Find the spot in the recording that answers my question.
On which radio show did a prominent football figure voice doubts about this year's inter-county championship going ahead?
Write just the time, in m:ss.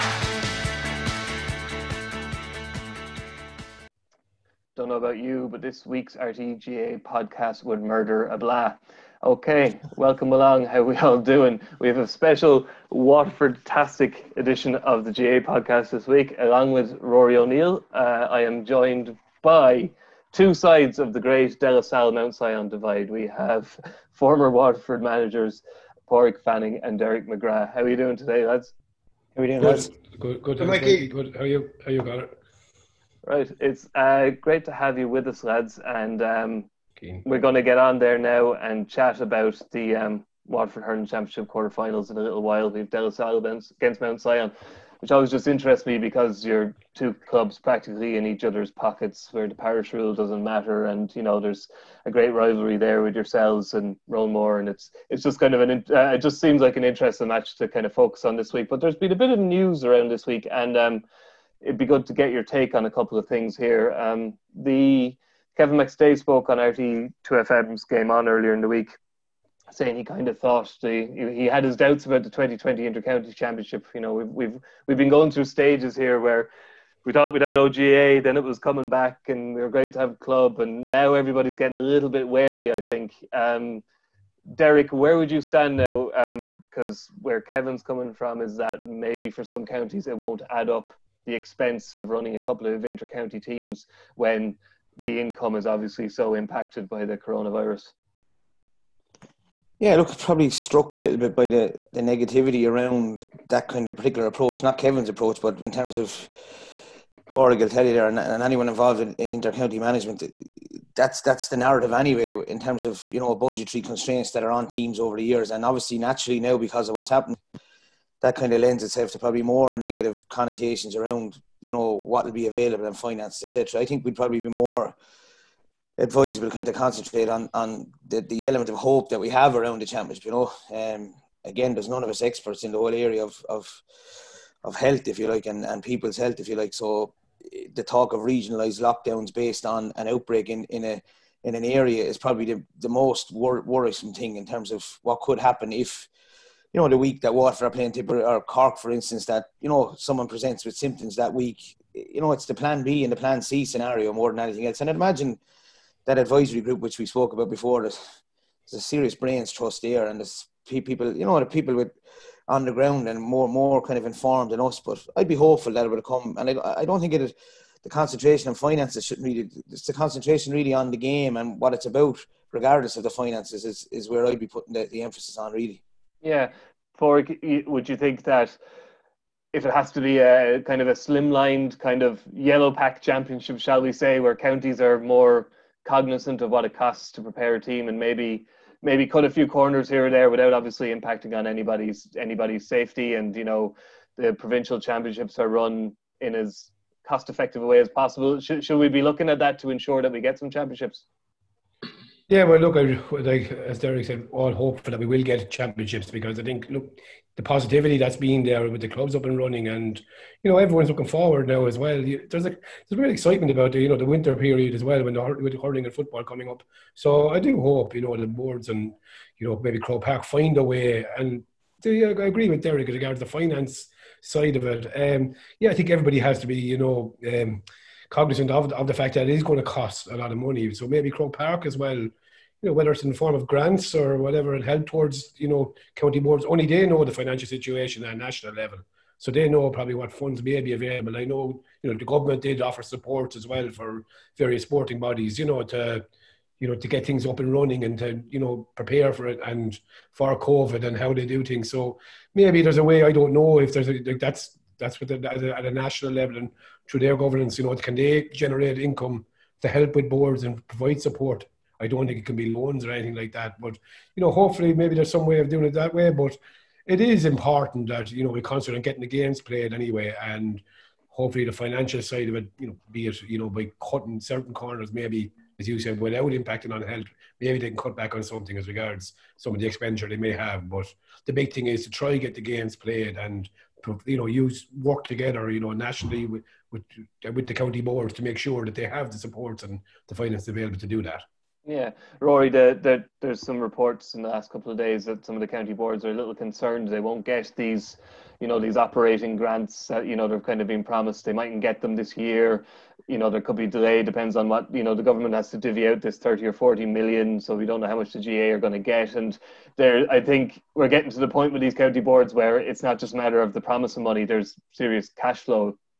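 1:07.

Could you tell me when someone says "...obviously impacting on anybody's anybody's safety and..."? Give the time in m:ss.
3:10.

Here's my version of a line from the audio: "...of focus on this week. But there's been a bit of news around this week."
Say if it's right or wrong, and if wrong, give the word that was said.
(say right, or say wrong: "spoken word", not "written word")
right.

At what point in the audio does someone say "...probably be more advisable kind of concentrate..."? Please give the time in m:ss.
2:04.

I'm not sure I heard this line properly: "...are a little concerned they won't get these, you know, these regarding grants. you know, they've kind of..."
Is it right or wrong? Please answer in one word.
wrong.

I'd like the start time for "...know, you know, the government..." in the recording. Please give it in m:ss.
4:01.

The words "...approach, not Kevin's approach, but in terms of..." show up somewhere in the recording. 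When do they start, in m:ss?
1:44.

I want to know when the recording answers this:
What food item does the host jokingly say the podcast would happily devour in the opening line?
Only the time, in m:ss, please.
0:08.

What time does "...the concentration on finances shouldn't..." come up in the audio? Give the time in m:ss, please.
2:47.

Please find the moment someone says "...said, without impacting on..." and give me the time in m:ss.
4:35.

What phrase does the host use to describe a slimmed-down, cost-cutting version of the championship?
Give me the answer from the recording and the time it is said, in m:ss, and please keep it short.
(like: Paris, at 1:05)
yellow pack championship, at 3:02.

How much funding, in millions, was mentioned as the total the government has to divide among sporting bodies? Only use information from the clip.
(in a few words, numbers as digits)
30 or 40 million.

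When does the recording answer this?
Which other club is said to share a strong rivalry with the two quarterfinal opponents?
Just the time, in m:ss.
0:54.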